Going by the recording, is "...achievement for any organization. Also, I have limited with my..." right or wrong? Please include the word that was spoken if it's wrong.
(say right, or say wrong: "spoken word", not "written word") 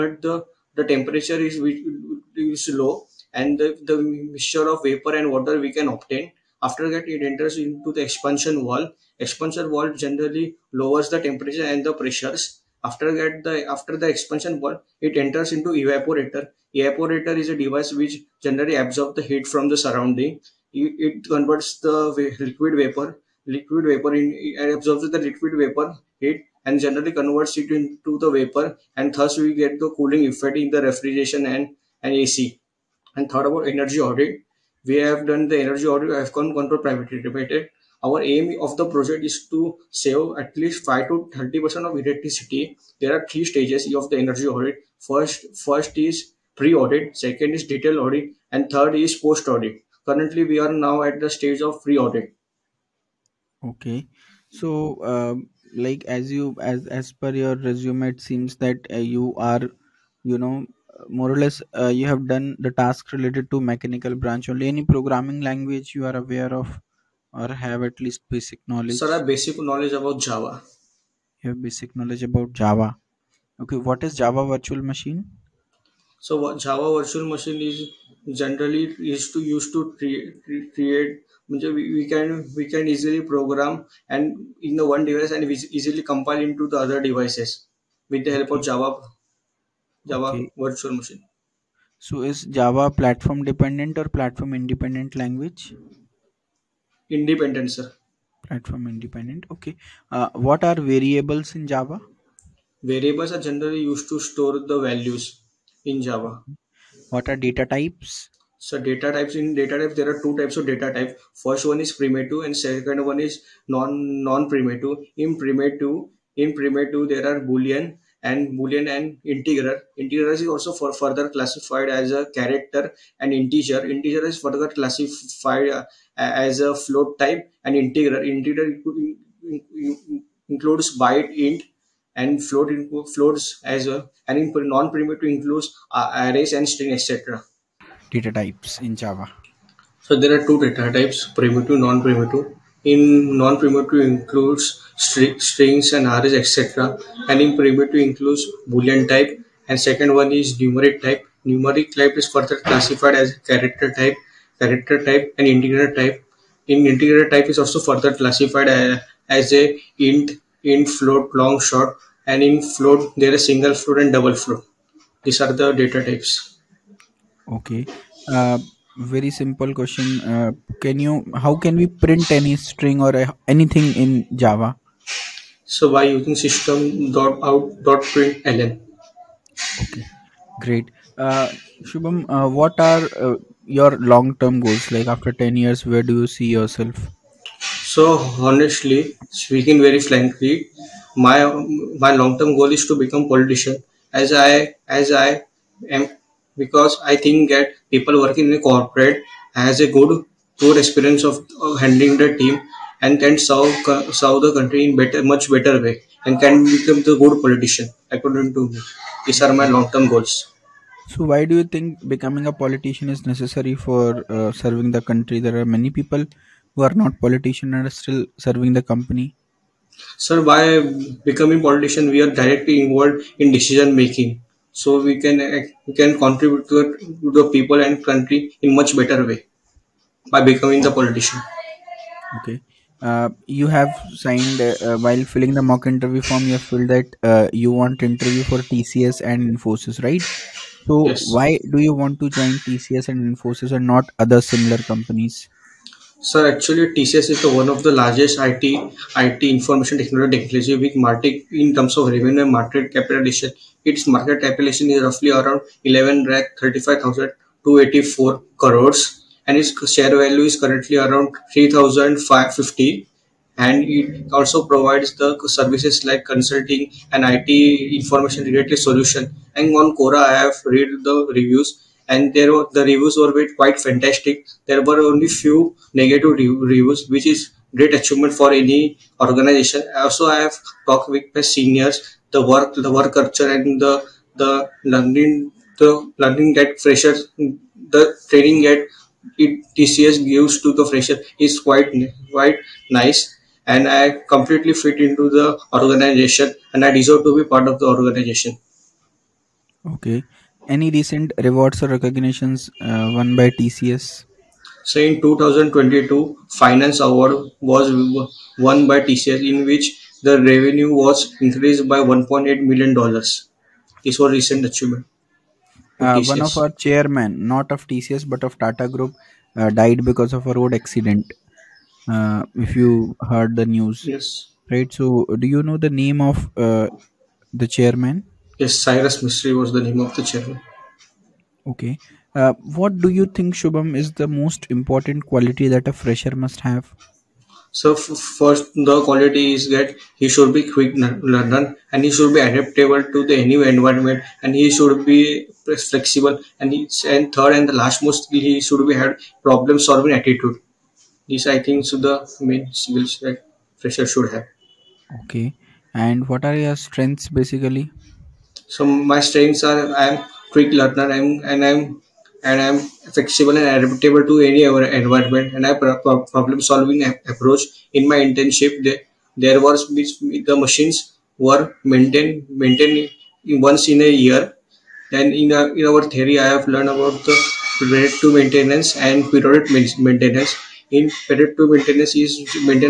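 wrong: "talked", not "limited".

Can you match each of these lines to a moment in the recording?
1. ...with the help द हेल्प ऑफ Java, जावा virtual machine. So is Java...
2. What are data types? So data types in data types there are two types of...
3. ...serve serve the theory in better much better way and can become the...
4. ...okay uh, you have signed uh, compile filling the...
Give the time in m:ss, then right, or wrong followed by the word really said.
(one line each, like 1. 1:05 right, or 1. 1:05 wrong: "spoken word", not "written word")
1. 1:28 right
2. 1:47 right
3. 3:23 wrong: "country", not "theory"
4. 3:52 wrong: "while", not "compile".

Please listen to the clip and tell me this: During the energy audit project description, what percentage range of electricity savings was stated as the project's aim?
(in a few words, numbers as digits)
5 to 30%.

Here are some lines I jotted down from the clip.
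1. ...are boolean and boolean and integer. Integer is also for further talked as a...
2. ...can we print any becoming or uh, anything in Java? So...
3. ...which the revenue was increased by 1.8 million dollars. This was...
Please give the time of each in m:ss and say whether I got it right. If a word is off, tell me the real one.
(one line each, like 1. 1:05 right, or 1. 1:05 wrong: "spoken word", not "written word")
1. 1:57 wrong: "classified", not "talked"
2. 2:51 wrong: "string", not "becoming"
3. 5:09 right.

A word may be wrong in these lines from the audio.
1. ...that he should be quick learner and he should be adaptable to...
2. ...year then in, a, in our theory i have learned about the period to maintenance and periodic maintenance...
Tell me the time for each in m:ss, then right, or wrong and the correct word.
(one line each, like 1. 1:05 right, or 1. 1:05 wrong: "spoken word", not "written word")
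1. 5:39 right
2. 6:14 right.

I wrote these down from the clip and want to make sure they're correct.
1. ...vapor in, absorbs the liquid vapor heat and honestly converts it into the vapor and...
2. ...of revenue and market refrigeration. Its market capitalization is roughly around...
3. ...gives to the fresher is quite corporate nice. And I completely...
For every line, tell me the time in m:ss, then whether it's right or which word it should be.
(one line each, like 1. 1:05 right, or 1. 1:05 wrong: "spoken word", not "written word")
1. 0:23 wrong: "generally", not "honestly"
2. 4:11 wrong: "capitalization", not "refrigeration"
3. 4:50 wrong: "quite", not "corporate".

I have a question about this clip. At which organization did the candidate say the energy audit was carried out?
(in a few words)
AFCON control privately limited.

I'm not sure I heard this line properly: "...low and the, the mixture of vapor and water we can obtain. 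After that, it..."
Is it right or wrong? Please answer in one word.
right.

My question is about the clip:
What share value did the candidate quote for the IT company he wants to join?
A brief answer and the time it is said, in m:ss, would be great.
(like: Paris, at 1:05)
3,550, at 4:21.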